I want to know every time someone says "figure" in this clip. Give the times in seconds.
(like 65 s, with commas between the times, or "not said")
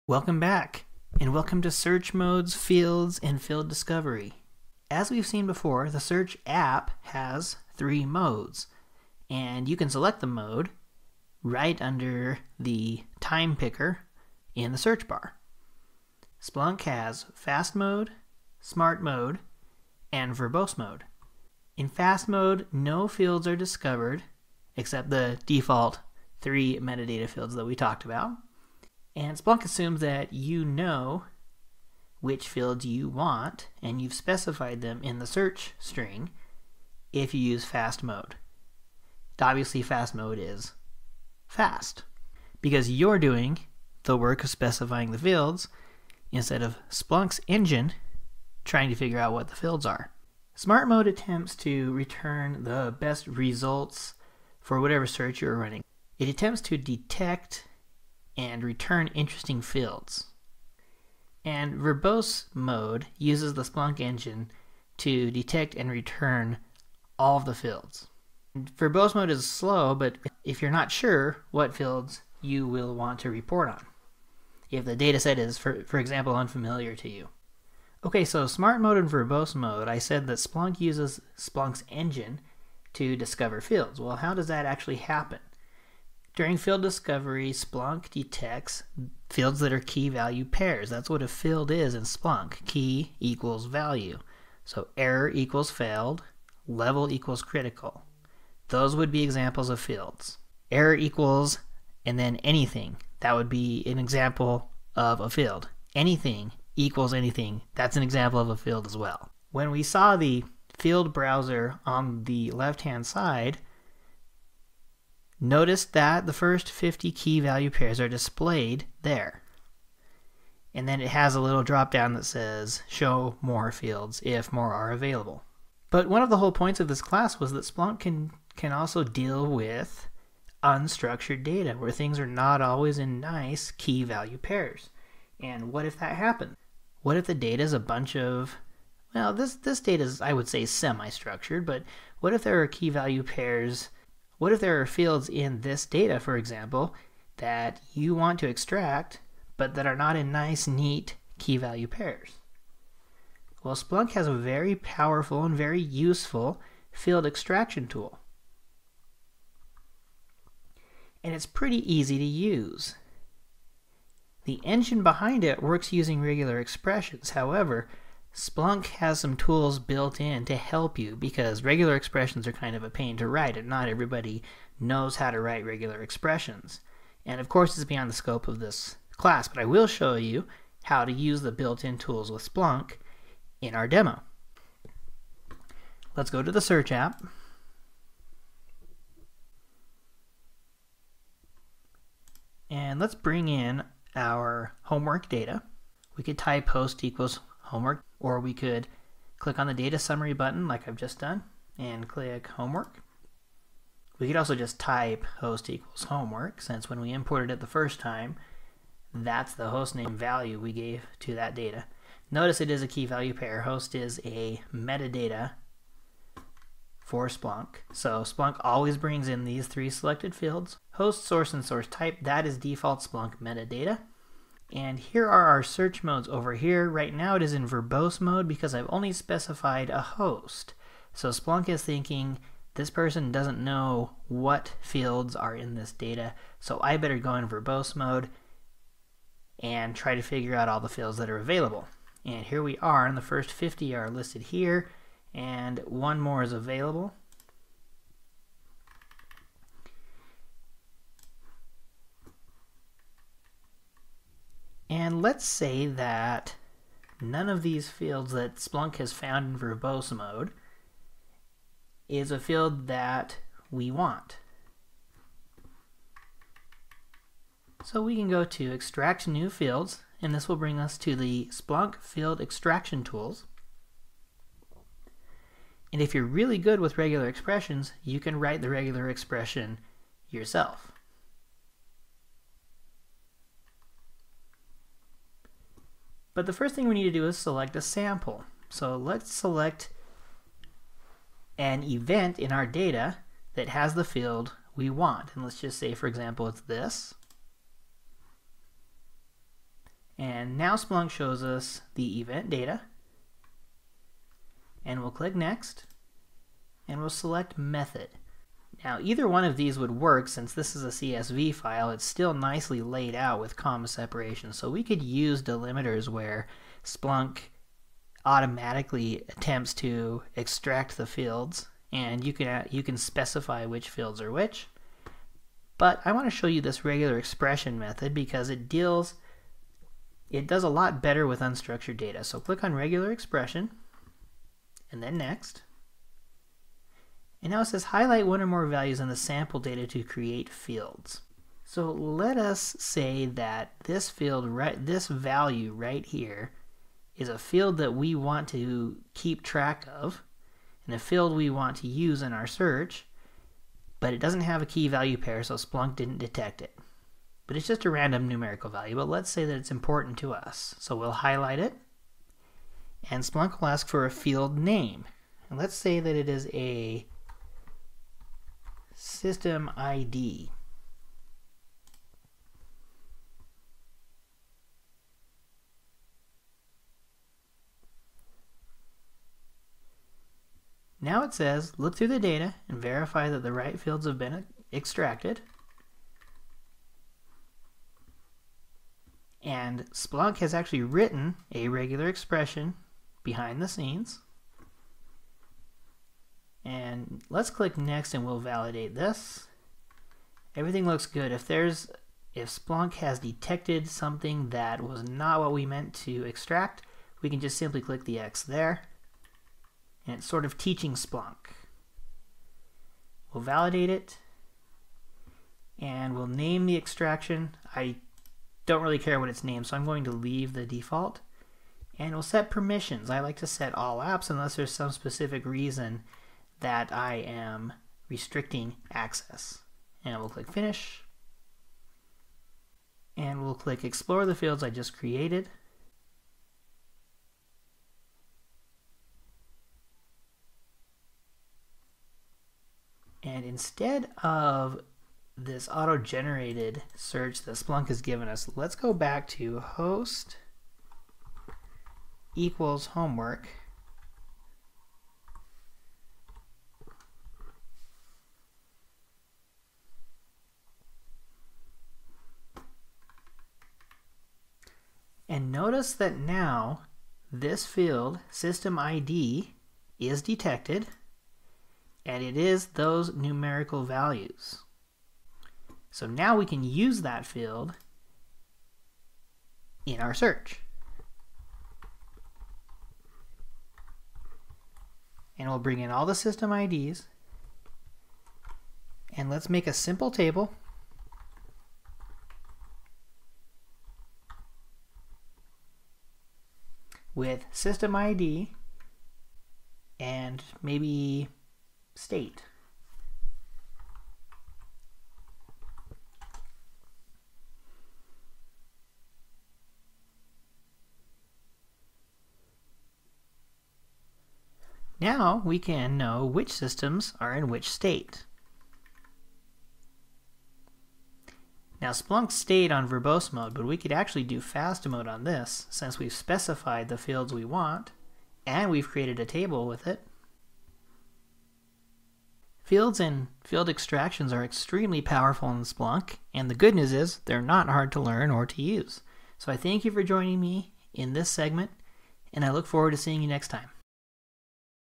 48 s, 240 s.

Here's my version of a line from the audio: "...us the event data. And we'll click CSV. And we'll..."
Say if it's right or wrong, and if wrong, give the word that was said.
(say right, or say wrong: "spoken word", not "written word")
wrong: "Next", not "CSV".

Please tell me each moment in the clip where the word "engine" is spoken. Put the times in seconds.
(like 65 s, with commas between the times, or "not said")
47 s, 63 s, 81 s, 164 s.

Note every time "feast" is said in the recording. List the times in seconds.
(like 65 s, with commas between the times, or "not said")
not said.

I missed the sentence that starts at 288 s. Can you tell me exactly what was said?
So let's select an event in our data that has the field we want.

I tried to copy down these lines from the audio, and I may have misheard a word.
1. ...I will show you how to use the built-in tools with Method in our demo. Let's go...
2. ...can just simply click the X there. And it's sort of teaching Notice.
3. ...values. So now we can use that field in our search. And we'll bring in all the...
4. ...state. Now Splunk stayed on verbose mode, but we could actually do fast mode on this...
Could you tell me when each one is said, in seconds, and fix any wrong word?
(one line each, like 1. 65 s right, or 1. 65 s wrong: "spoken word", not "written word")
1. 179 s wrong: "Splunk", not "Method"
2. 407 s wrong: "Splunk", not "Notice"
3. 473 s right
4. 517 s right.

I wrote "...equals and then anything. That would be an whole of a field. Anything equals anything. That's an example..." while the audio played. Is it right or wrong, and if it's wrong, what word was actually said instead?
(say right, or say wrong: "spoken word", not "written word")
wrong: "example", not "whole".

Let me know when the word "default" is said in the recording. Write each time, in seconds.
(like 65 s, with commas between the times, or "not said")
25 s, 222 s, 420 s.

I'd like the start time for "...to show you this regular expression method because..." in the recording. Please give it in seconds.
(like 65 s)
326 s.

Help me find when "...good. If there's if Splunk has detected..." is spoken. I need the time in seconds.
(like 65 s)
401 s.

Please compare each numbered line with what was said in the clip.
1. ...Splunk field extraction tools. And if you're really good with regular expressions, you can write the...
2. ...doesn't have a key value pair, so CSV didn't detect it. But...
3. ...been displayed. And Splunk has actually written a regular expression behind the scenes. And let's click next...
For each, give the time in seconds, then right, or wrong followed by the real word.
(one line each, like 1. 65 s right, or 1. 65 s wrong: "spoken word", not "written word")
1. 271 s right
2. 354 s wrong: "Splunk", not "CSV"
3. 384 s wrong: "extracted", not "displayed".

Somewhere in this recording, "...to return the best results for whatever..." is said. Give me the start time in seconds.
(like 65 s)
51 s.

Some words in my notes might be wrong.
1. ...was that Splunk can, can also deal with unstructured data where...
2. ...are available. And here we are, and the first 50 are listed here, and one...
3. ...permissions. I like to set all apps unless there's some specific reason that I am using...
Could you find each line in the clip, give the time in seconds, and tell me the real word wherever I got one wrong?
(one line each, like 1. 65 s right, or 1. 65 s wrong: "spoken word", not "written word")
1. 127 s right
2. 241 s right
3. 422 s wrong: "restricting", not "using".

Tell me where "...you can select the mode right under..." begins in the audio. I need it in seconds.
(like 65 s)
9 s.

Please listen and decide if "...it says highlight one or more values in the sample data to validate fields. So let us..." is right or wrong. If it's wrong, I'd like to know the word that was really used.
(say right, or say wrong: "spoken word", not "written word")
wrong: "create", not "validate".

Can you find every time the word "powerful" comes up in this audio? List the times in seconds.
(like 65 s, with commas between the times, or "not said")
154 s, 535 s.